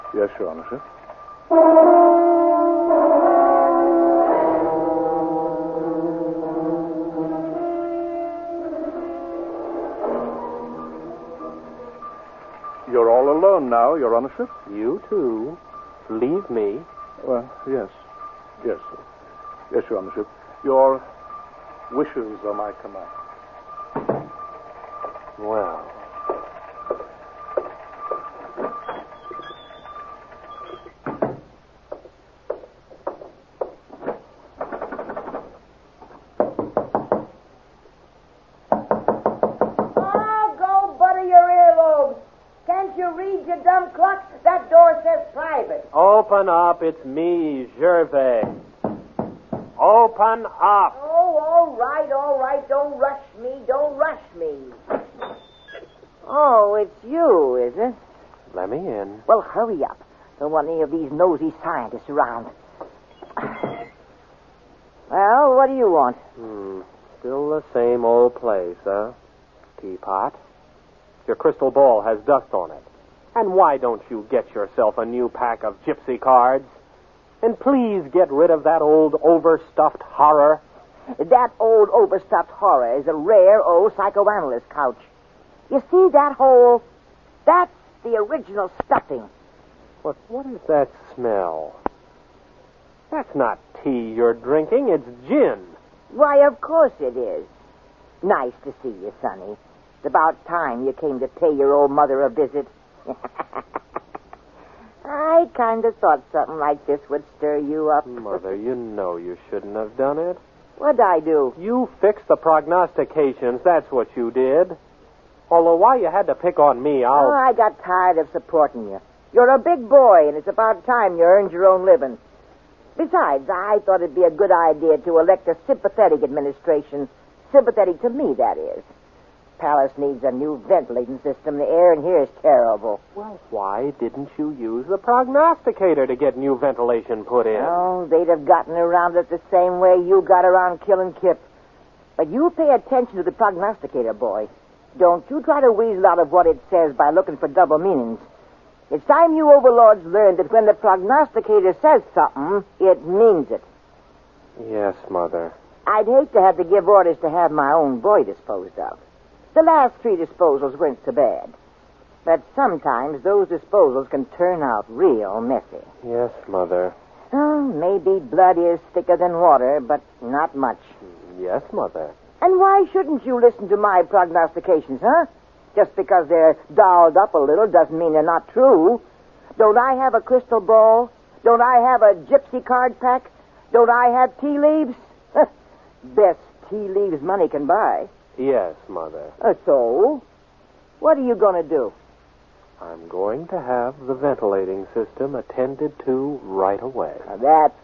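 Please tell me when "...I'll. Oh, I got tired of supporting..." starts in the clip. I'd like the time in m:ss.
1:57.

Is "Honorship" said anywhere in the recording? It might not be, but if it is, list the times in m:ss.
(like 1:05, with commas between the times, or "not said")
0:00, 0:14, 0:20.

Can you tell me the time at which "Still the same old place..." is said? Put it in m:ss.
1:07.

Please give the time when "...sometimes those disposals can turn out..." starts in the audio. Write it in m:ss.
2:42.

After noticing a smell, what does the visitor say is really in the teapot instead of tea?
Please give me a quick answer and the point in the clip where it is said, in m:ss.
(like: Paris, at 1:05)
Gin, at 1:35.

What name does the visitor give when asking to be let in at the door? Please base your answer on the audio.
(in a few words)
Gervais.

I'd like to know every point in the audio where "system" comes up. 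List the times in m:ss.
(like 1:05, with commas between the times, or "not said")
2:11, 3:14.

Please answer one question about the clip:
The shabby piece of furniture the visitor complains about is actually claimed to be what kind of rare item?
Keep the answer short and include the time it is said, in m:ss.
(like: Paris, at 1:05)
Psychoanalyst couch, at 1:23.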